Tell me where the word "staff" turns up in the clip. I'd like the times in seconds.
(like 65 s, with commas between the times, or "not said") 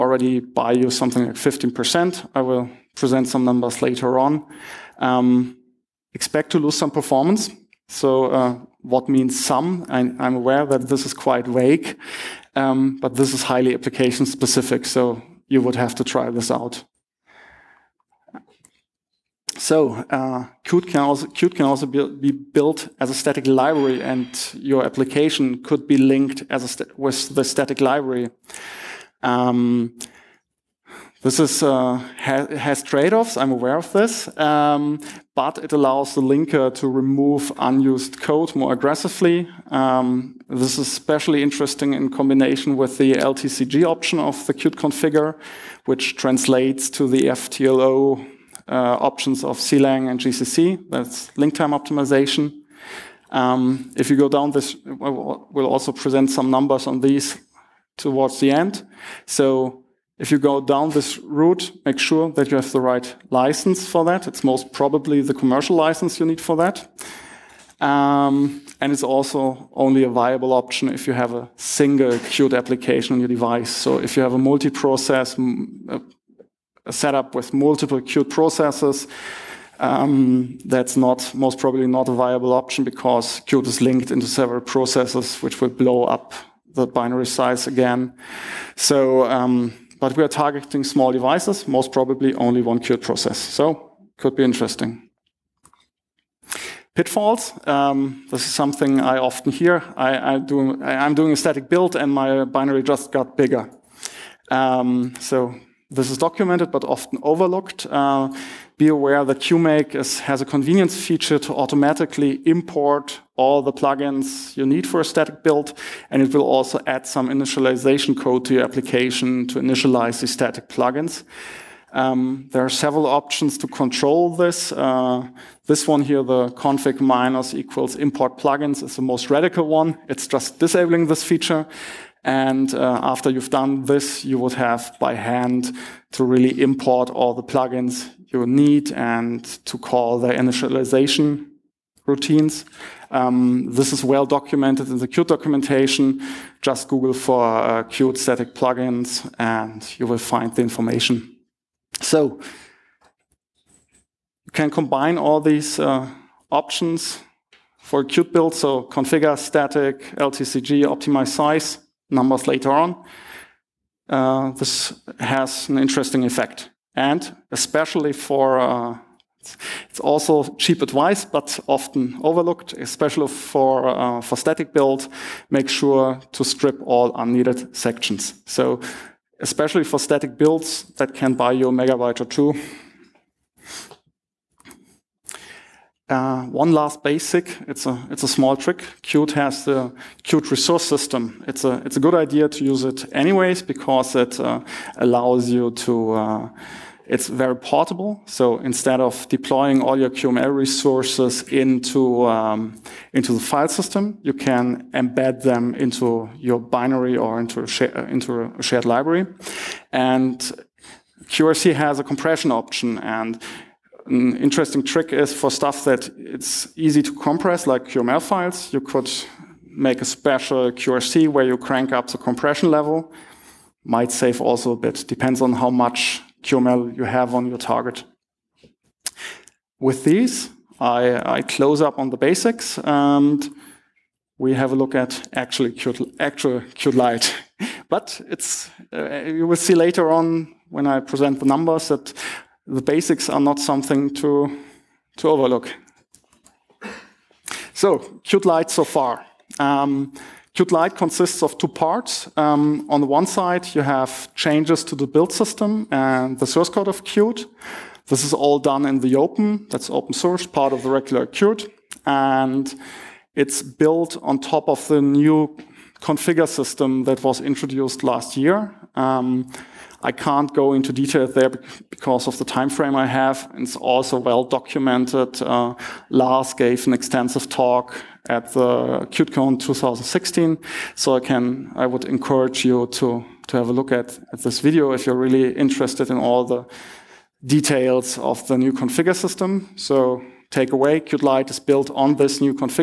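not said.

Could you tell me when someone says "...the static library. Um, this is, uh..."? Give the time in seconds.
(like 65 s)
27 s.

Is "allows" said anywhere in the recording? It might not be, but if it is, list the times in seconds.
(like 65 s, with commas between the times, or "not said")
35 s, 194 s.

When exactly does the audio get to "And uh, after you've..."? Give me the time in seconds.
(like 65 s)
132 s.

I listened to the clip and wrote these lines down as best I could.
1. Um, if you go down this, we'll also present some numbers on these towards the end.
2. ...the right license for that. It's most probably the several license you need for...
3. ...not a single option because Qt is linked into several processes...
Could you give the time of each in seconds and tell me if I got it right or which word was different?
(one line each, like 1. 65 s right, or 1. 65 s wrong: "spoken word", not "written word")
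1. 53 s right
2. 62 s wrong: "commercial", not "several"
3. 81 s wrong: "viable", not "single".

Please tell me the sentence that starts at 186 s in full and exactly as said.
Uh, one last basic, it's a, it's a small trick.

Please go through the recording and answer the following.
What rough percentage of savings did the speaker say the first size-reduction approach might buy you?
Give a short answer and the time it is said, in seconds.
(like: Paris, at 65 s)
15%, at 1 s.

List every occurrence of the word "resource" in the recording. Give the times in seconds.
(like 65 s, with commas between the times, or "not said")
190 s, 200 s.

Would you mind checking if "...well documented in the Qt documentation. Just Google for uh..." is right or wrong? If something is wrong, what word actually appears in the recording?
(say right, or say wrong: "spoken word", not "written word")
right.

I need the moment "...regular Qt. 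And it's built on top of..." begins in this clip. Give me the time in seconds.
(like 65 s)
260 s.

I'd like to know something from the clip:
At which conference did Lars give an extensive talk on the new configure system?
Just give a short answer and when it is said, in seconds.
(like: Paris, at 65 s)
QtCon 2016, at 279 s.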